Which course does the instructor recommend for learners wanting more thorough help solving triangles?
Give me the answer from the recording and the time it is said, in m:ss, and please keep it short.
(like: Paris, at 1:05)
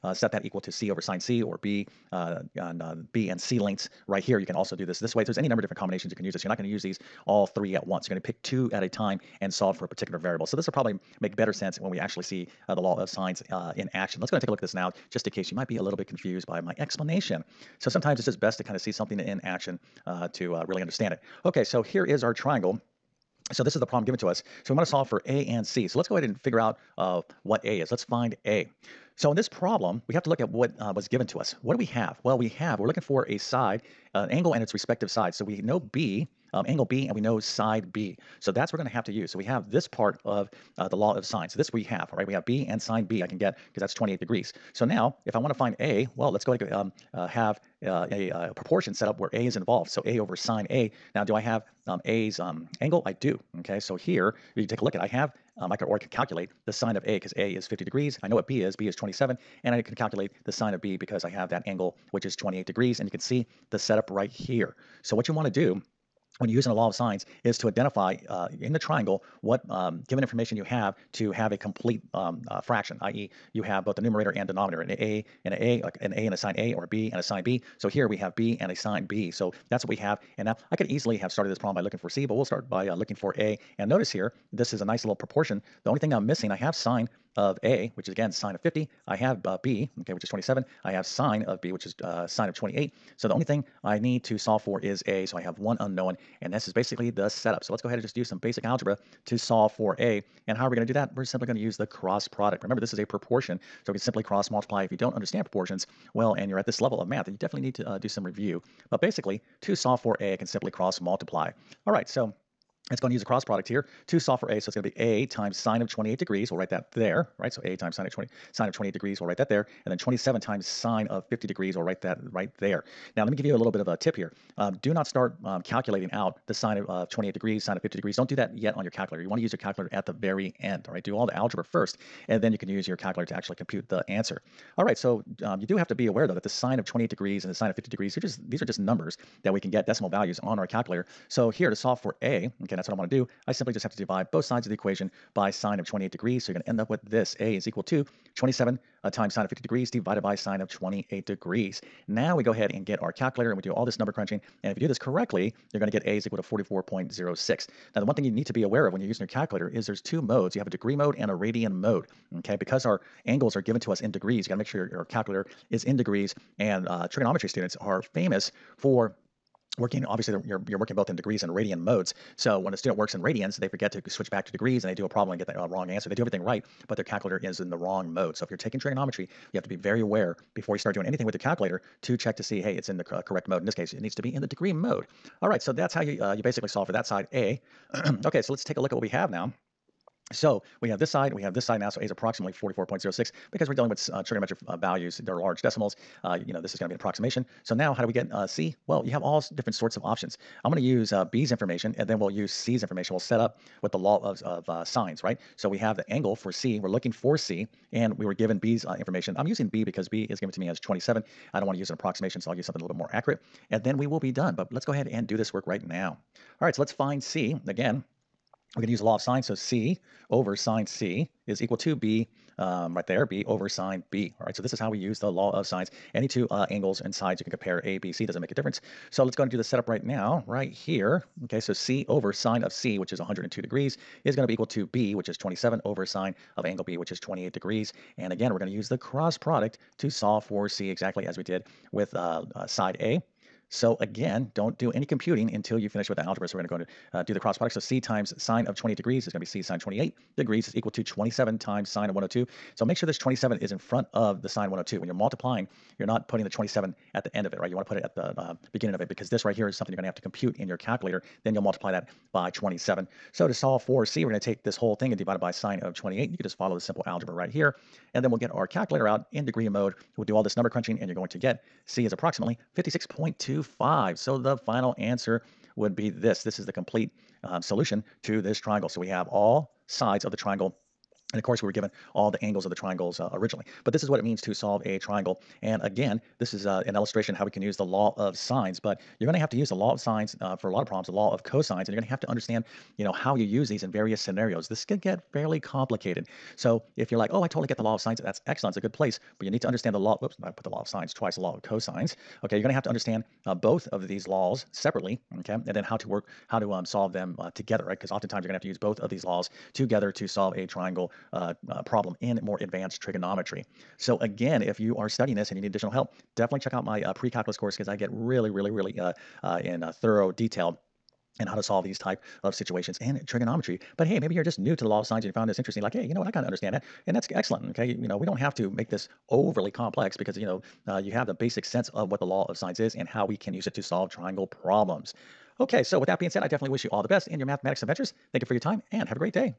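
pre-calculus course, at 5:17.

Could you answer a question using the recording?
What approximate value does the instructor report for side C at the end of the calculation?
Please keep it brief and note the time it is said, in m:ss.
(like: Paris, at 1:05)
56.25, at 4:32.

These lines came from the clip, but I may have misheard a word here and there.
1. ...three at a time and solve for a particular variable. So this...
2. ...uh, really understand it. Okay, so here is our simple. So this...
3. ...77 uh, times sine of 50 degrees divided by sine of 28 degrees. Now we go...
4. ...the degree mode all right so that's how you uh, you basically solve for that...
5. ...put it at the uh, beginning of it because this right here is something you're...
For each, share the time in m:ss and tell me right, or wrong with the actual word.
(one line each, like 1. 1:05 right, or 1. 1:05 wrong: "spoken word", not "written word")
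1. 0:08 wrong: "two", not "three"
2. 0:20 wrong: "triangle", not "simple"
3. 2:28 wrong: "27", not "77"
4. 3:04 right
5. 4:17 right.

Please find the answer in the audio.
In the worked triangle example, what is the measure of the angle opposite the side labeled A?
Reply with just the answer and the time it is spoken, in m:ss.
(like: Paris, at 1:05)
50 degrees, at 0:57.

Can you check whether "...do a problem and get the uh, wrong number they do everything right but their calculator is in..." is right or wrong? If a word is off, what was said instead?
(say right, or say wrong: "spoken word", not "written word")
wrong: "answer", not "number".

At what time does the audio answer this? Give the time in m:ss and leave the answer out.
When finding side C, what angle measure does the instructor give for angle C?
3:53.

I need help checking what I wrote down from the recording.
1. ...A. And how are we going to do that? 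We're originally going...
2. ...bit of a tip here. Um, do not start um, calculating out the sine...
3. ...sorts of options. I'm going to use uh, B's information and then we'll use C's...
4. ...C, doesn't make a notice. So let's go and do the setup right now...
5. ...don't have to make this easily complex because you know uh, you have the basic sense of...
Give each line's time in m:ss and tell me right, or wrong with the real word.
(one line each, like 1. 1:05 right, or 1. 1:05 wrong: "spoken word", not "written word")
1. 1:39 wrong: "simply", not "originally"
2. 2:03 right
3. 3:19 right
4. 3:48 wrong: "difference", not "notice"
5. 5:28 wrong: "overly", not "easily".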